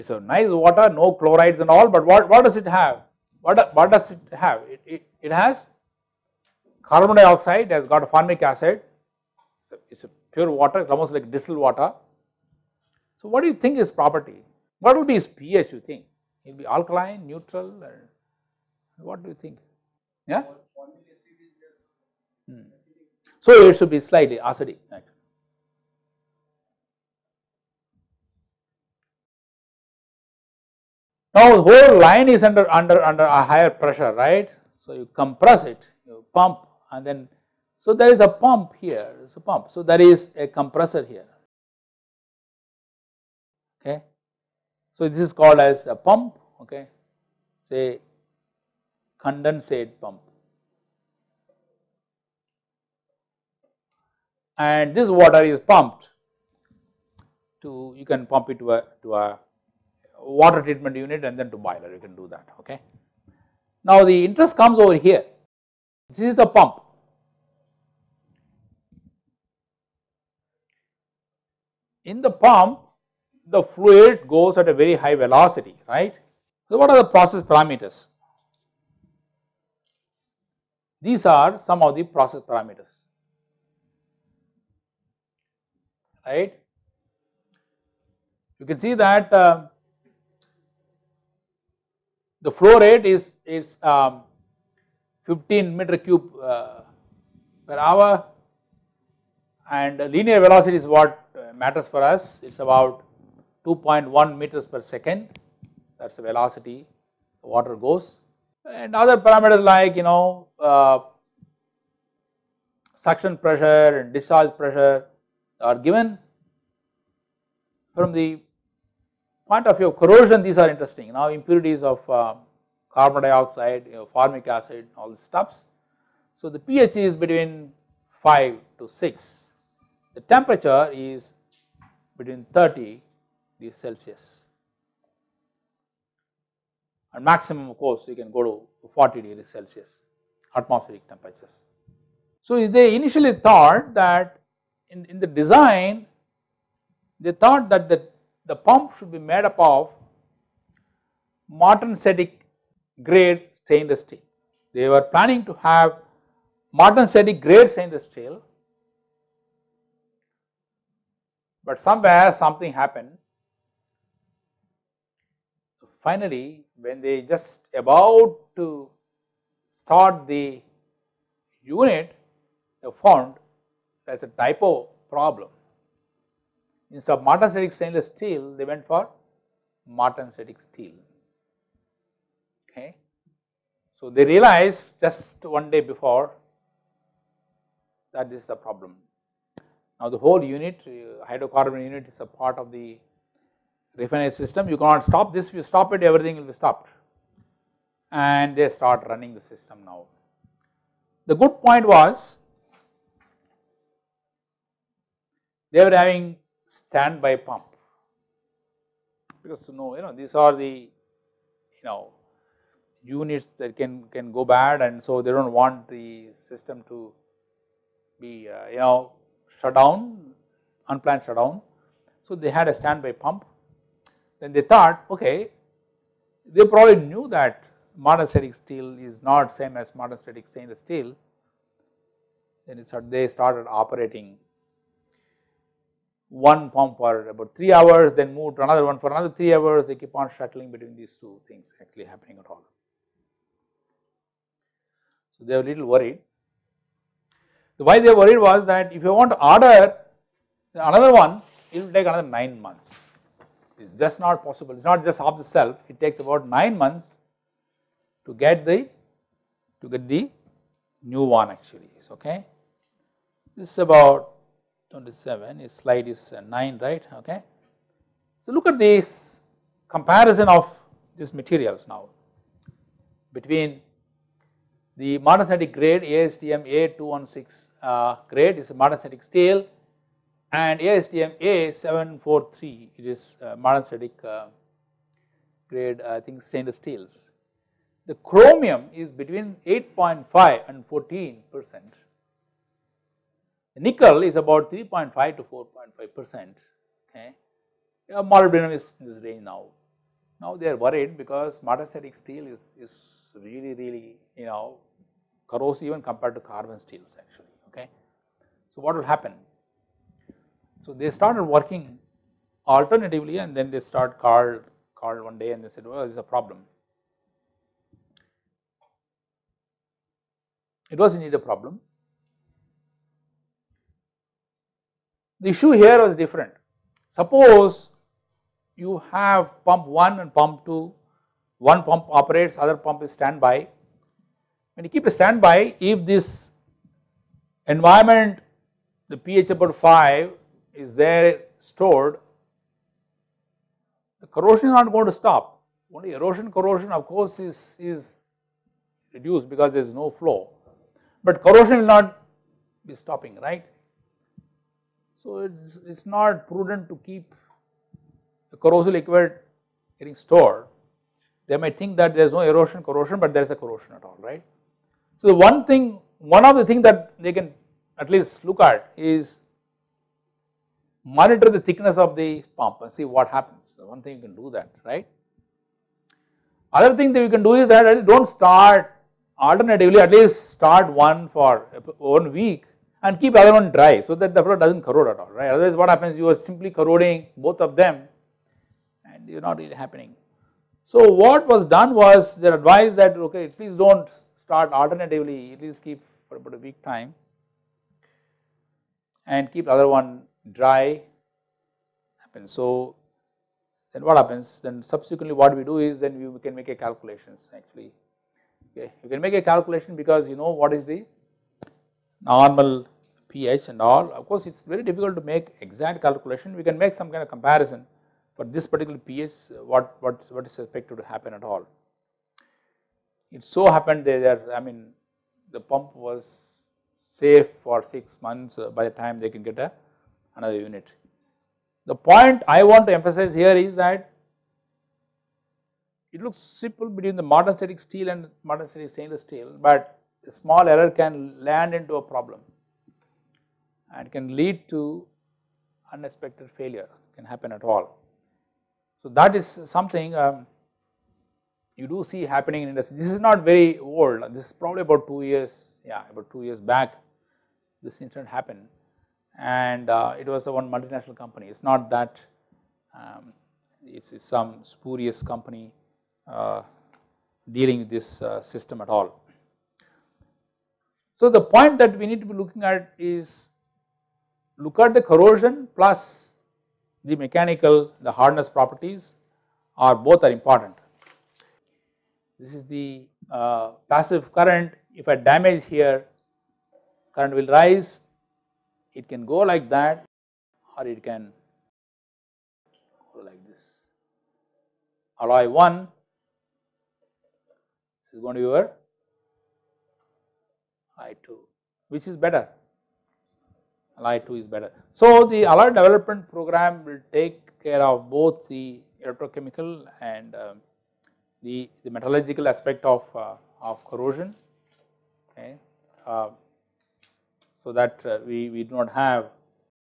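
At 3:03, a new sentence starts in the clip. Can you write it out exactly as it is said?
So, they realized just one day before that is the problem.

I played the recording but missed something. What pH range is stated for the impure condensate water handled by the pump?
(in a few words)
5 to 6.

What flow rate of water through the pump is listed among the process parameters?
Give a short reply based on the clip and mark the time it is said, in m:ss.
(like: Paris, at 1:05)
15 cubic meters per hour, at 1:35.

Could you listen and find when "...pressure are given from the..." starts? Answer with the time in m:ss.
1:54.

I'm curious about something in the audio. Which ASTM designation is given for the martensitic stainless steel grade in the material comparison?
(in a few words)
ASTM A743.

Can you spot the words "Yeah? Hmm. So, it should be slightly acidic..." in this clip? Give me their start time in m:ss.
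0:20.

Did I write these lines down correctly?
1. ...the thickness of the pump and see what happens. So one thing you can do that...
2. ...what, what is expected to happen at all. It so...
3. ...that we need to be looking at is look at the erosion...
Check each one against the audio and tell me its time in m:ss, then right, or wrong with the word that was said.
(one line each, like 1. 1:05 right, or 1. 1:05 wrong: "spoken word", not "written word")
1. 6:11 right
2. 7:00 right
3. 7:51 wrong: "corrosion", not "erosion".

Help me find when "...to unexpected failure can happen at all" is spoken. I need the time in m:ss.
7:24.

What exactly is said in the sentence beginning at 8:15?
Alloy 1 is going to be your alloy 2 which is better alloy 2 is better.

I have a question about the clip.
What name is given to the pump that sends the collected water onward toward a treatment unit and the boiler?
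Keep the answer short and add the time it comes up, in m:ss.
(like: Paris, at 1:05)
condensate pump, at 0:49.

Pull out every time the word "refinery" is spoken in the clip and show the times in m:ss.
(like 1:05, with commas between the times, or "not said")
3:14.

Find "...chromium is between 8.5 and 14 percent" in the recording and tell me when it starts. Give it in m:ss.
4:48.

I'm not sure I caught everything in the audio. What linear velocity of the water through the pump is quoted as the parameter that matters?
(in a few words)
2.1 meters per second.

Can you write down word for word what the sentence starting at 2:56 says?
Instead of martensitic stainless steel, they went for martensitic steel.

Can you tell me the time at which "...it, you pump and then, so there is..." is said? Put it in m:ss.
0:35.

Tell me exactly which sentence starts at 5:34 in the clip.
When you keep a standby, if this environment the pH about 5 is there stored, the corrosion is not going to stop.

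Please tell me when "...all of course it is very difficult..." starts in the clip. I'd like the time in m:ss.
6:53.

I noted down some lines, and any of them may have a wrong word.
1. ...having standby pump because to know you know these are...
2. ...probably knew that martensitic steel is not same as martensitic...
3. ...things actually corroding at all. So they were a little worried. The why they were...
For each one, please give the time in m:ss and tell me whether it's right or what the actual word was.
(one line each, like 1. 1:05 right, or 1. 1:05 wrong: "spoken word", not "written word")
1. 3:25 right
2. 3:46 right
3. 4:01 wrong: "happening", not "corroding".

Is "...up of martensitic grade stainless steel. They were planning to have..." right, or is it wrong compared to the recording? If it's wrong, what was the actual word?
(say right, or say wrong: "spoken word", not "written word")
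right.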